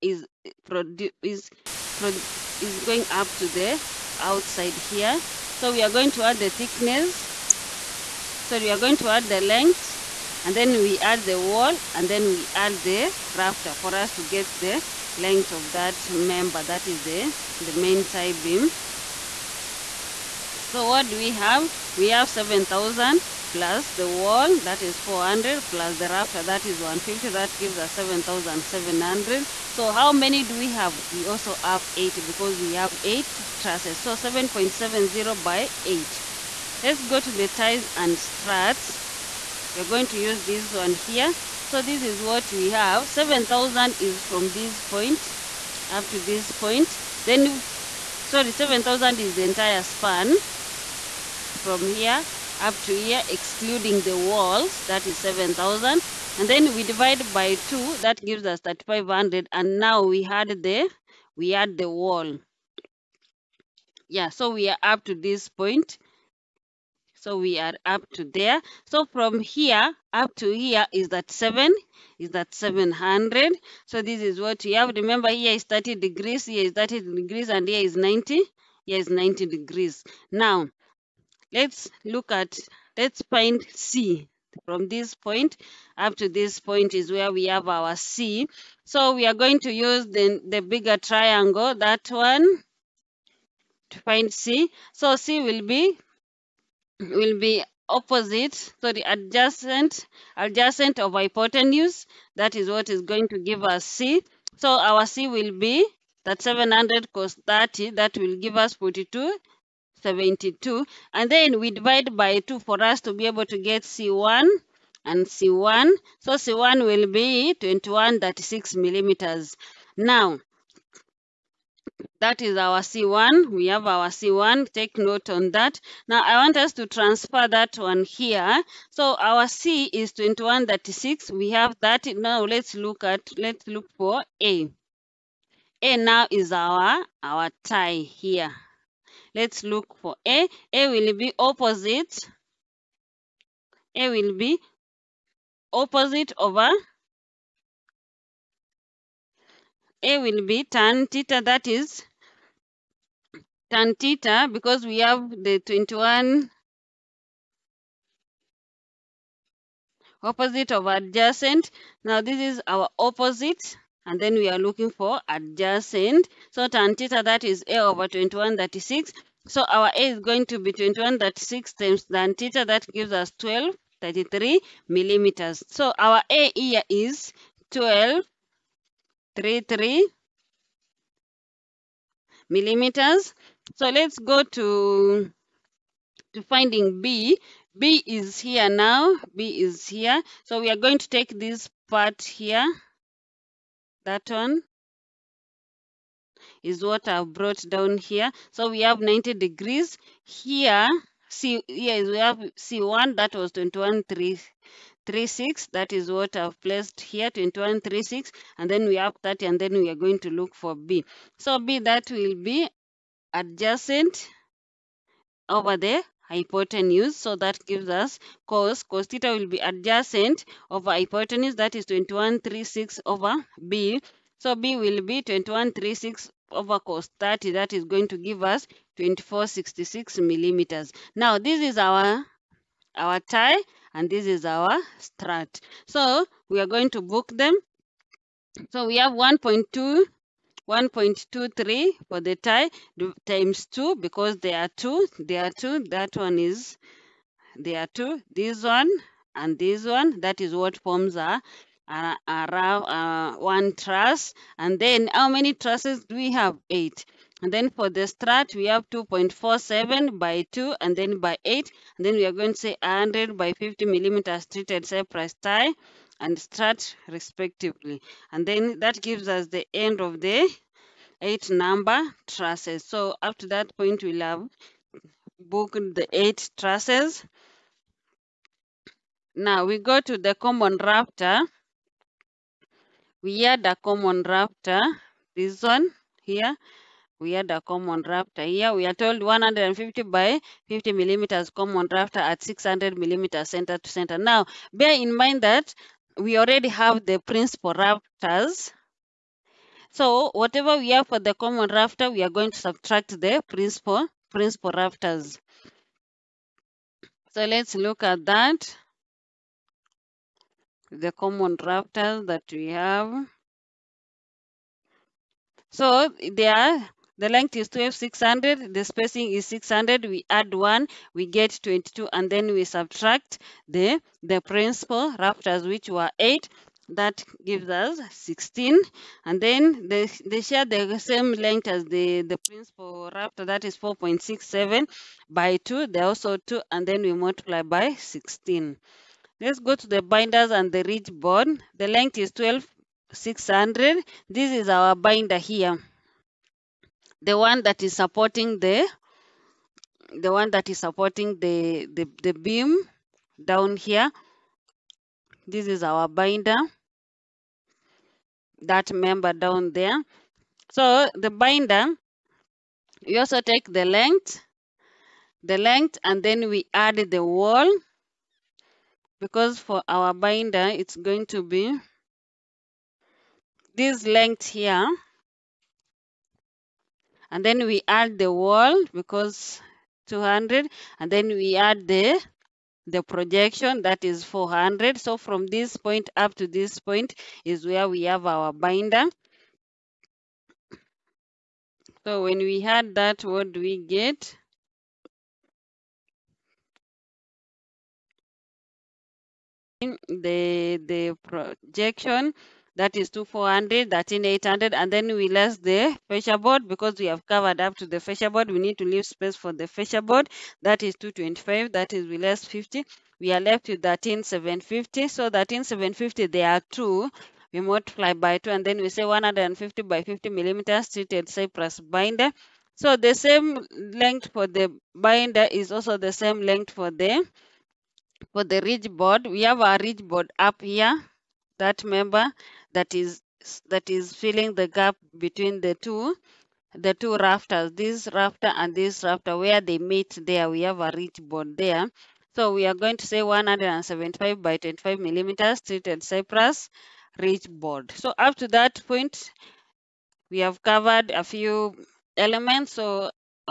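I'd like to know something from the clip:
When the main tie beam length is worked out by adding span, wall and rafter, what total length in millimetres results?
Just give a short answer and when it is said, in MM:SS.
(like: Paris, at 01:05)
7,700, at 00:27.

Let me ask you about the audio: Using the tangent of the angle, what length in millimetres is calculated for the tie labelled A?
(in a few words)
1233 millimeters.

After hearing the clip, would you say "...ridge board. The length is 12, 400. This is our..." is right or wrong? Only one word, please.
wrong.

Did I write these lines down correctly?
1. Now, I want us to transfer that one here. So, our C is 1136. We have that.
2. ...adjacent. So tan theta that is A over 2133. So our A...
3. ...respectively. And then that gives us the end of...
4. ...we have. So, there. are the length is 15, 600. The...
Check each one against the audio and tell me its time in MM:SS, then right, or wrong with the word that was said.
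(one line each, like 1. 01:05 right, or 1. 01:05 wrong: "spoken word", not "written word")
1. 02:06 wrong: "2136", not "1136"
2. 02:45 wrong: "2136", not "2133"
3. 04:27 right
4. 05:12 wrong: "12", not "15".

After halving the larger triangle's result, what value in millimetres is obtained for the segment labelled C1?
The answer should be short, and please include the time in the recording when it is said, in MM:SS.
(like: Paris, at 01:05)
2136, at 01:56.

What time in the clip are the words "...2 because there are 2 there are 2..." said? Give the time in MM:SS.
04:03.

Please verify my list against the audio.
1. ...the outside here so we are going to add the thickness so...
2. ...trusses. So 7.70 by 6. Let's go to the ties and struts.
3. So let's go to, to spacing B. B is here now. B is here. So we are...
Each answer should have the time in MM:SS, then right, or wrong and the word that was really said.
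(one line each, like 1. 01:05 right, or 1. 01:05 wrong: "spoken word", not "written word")
1. 00:03 right
2. 00:33 wrong: "8", not "6"
3. 03:03 wrong: "finding", not "spacing".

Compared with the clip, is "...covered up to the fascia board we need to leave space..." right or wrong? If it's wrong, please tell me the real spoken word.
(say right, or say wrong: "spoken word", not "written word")
right.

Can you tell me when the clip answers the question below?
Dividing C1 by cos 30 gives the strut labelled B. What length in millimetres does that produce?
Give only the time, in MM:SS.
03:48.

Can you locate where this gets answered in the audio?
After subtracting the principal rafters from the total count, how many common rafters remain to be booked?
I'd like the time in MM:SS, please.
05:26.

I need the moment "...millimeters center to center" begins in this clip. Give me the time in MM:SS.
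04:52.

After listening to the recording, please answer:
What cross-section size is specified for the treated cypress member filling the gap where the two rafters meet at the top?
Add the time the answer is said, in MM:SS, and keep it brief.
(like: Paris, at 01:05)
175 by 25 millimeters, at 07:23.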